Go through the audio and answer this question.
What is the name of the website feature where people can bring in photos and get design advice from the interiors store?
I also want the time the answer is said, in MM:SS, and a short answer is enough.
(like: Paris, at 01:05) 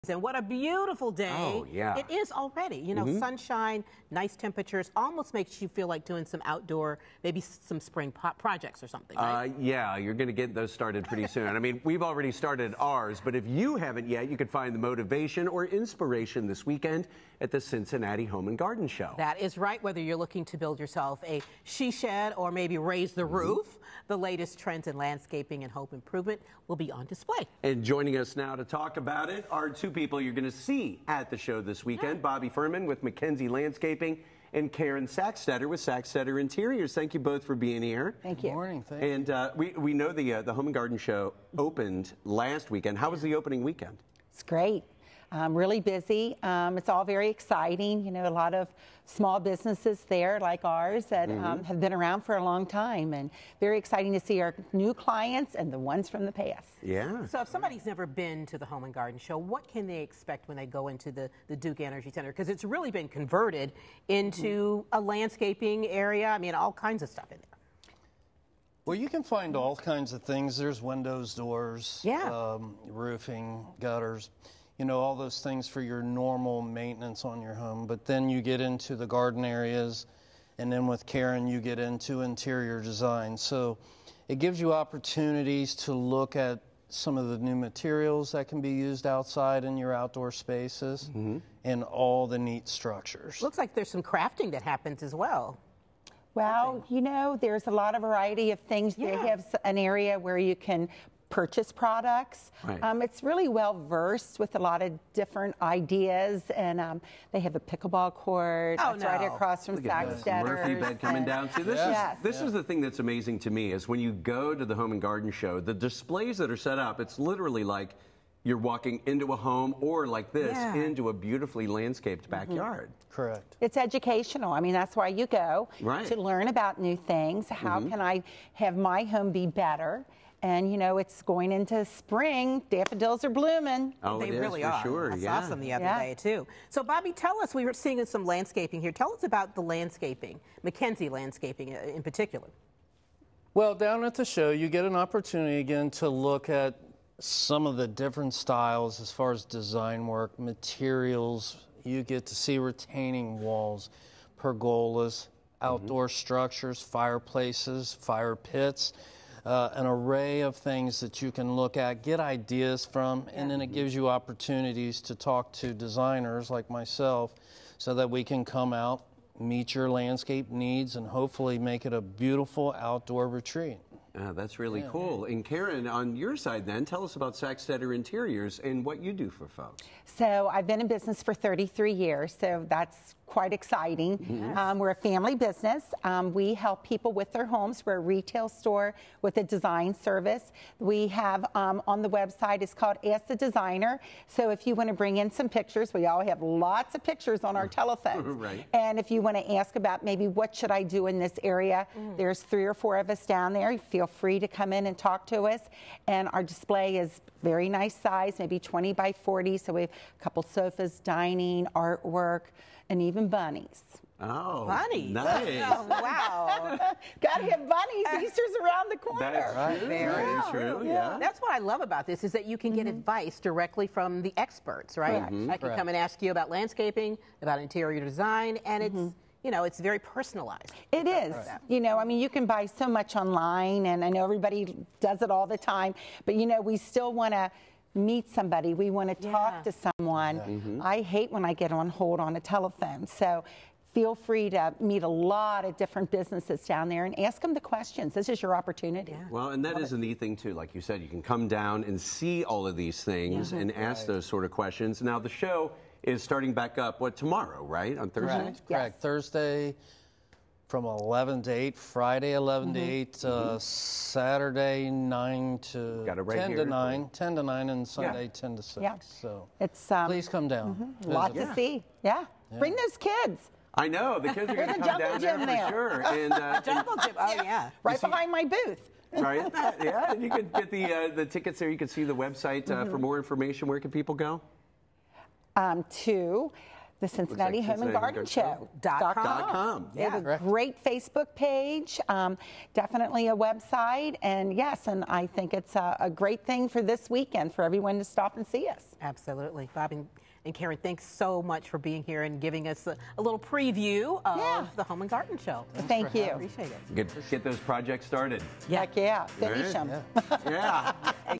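Ask the Designer, at 03:13.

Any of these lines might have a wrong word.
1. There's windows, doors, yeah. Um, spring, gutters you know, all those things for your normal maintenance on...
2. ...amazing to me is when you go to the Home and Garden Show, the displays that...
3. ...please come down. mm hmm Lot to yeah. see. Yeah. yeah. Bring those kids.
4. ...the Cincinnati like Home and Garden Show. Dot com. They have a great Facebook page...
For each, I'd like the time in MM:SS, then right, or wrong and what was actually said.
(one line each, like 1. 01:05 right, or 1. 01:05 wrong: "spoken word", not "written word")
1. 01:10 wrong: "roofing", not "spring"
2. 01:52 right
3. 04:30 right
4. 04:46 right.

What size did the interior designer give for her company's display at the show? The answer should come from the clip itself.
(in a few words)
20 by 40.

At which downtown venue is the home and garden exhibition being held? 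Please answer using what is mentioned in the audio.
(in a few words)
Duke Energy Center.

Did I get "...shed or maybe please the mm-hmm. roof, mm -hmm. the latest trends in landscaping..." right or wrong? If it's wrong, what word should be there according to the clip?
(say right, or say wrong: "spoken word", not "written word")
wrong: "raise", not "please".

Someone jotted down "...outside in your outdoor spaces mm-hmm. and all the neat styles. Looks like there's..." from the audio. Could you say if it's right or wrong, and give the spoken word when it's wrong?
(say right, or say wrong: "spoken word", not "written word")
wrong: "structures", not "styles".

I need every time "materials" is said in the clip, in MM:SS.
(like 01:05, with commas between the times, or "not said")
01:27, 02:30.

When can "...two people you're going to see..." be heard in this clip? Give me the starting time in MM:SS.
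00:29.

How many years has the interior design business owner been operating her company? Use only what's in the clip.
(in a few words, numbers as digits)
33.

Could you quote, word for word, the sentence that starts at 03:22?
there's three or four of us down there.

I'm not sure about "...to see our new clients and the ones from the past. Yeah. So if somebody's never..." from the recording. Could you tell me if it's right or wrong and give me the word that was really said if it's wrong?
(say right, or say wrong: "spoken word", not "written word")
right.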